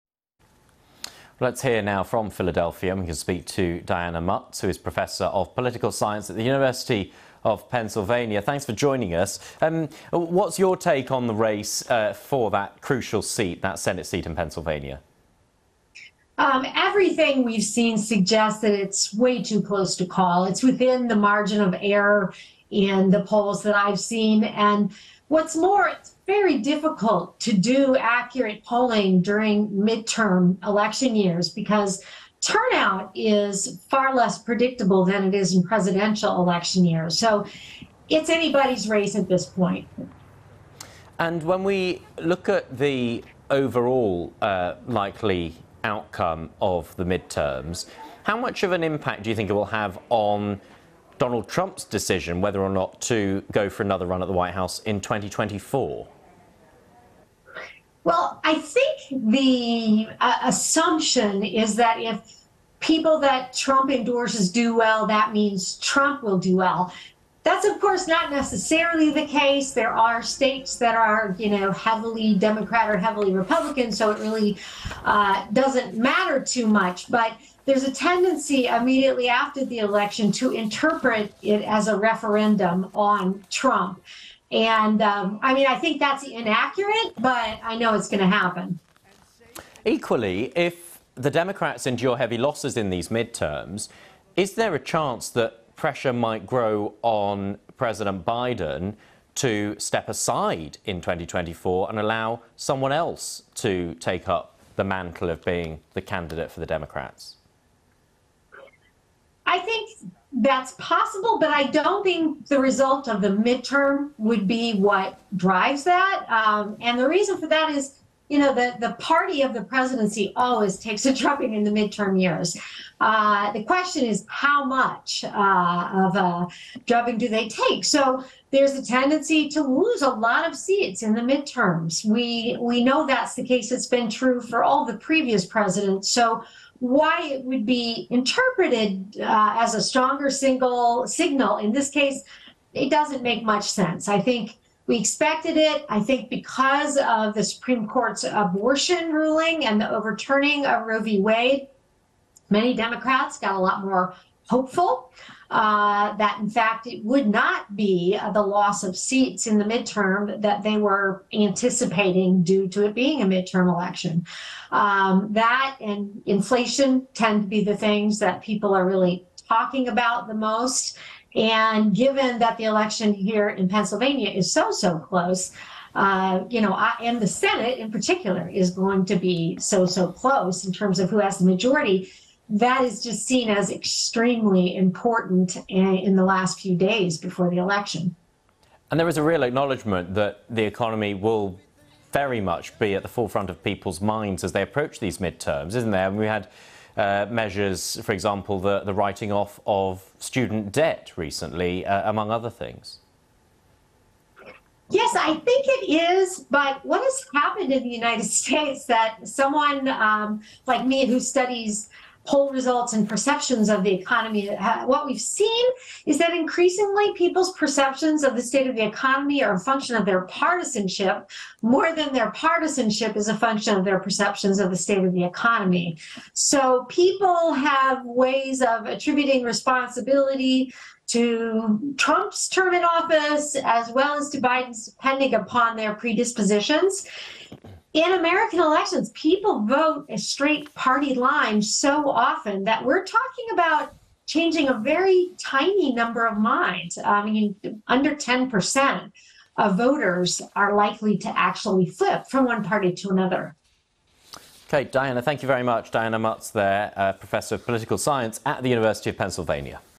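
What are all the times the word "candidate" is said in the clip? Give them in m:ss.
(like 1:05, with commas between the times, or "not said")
1:46.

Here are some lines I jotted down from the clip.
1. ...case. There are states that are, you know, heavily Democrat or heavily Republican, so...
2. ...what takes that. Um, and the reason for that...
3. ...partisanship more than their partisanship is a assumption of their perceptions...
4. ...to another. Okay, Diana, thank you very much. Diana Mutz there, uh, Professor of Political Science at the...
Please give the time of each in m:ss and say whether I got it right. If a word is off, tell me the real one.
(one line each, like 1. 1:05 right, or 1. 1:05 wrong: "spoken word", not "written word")
1. 1:09 right
2. 1:54 wrong: "drives", not "takes"
3. 3:40 wrong: "function", not "assumption"
4. 4:12 right.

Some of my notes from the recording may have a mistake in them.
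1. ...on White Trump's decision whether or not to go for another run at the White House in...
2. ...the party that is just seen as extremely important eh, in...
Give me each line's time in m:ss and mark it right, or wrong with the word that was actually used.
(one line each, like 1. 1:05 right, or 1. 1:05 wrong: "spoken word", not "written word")
1. 0:50 wrong: "Donald", not "White"
2. 3:01 wrong: "majority", not "party".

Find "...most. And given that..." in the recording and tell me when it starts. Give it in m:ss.
2:50.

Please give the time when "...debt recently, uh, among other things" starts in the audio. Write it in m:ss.
3:20.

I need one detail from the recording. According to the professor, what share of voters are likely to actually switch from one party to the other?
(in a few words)
under 10%.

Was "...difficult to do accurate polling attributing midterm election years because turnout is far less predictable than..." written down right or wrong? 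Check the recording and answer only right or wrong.
wrong.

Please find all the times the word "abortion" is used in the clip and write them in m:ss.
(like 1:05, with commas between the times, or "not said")
2:28.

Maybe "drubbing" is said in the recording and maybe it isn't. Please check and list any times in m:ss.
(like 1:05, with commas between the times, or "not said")
2:01, 2:06.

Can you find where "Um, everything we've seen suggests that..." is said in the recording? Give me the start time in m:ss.
0:16.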